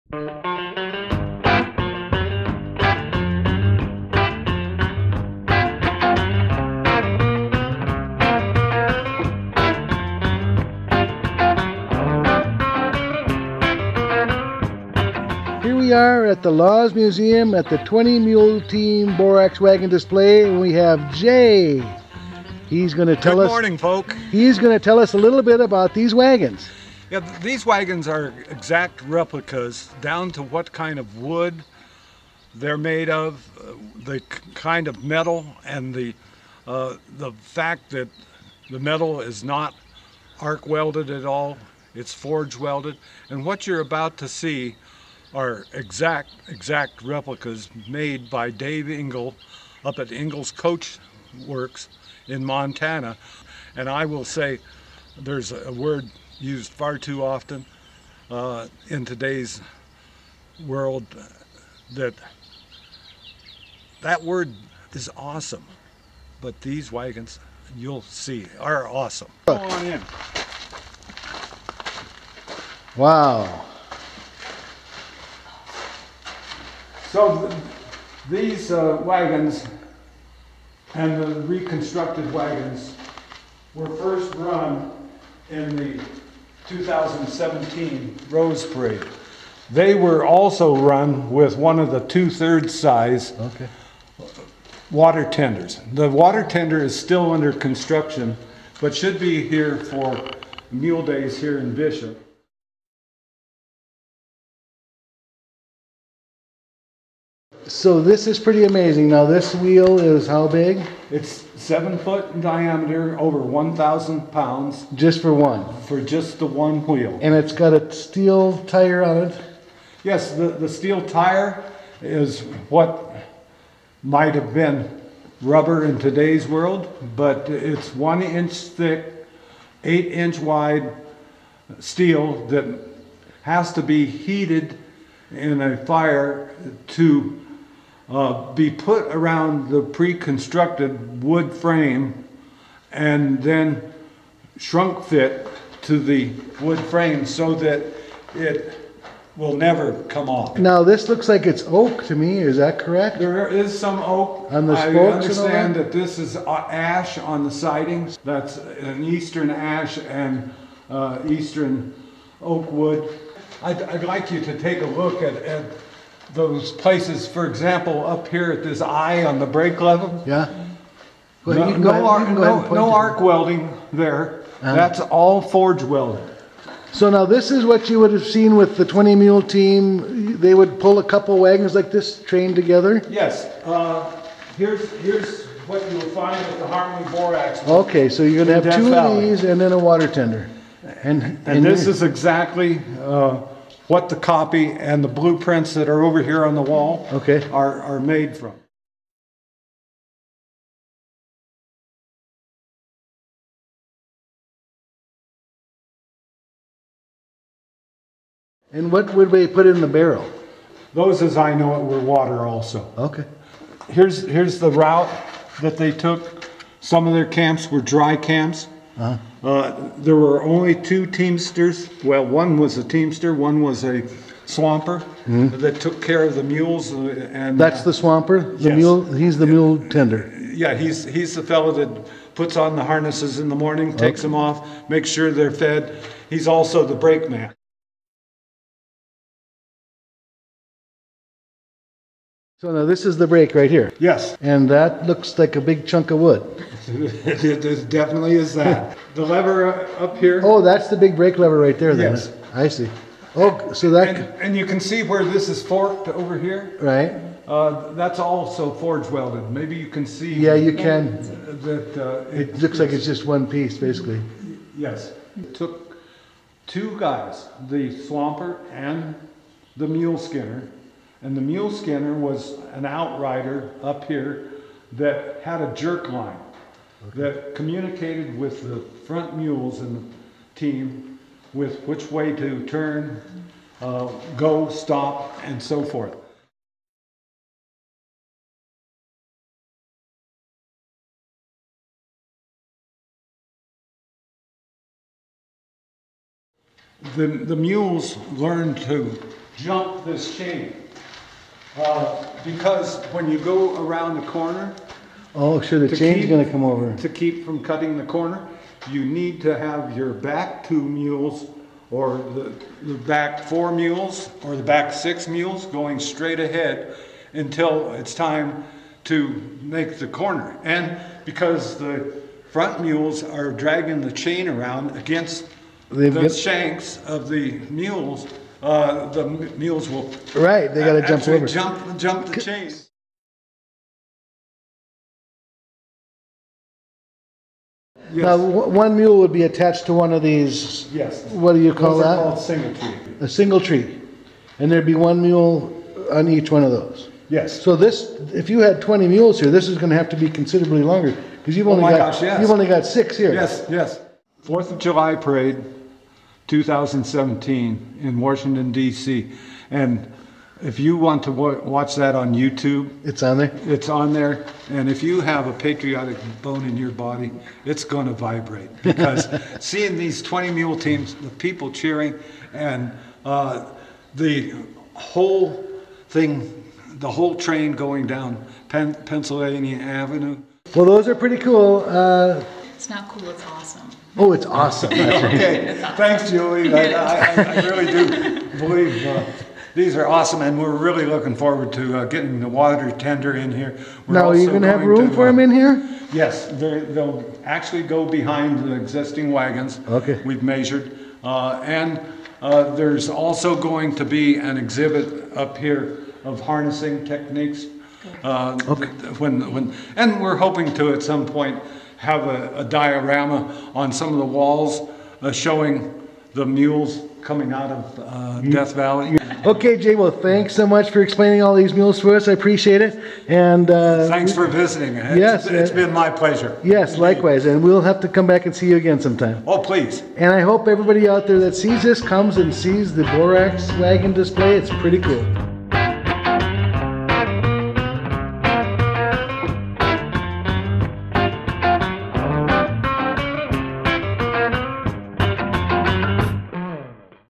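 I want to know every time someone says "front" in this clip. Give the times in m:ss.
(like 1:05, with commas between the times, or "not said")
4:39, 5:22.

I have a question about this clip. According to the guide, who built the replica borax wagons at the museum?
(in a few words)
Dave Engels.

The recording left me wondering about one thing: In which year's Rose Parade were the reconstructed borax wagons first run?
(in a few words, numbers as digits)
2017.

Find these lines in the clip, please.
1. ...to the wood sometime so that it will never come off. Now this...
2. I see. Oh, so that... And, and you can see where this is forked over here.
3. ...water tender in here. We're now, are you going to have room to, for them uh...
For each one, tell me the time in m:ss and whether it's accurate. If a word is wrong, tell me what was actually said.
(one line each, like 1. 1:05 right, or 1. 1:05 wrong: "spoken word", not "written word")
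1. 2:25 wrong: "frame", not "sometime"
2. 4:12 right
3. 6:32 right.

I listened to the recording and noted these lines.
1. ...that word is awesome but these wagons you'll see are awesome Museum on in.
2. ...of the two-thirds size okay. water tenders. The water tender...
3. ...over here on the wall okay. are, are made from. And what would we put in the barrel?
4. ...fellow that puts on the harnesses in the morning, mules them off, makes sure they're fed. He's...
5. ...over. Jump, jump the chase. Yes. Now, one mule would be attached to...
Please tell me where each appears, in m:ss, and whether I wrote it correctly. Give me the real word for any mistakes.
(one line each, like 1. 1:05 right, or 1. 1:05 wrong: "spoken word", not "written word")
1. 1:04 wrong: "Come", not "Museum"
2. 1:31 right
3. 3:16 right
4. 3:51 wrong: "takes", not "mules"
5. 5:31 right.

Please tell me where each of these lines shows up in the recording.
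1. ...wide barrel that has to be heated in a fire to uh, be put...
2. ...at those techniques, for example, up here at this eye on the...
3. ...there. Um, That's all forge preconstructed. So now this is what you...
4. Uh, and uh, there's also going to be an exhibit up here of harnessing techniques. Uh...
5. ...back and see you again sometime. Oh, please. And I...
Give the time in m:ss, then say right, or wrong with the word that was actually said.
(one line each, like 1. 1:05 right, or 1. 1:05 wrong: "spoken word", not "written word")
1. 2:10 wrong: "steel", not "barrel"
2. 2:45 wrong: "places", not "techniques"
3. 2:53 wrong: "welded", not "preconstructed"
4. 6:41 right
5. 7:08 right.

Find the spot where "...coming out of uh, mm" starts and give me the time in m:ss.
6:57.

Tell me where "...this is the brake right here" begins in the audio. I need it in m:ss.
4:02.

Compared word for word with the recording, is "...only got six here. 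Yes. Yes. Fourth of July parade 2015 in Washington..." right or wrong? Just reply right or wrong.
wrong.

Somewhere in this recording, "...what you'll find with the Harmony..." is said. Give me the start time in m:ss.
3:05.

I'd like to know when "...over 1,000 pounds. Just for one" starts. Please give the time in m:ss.
1:53.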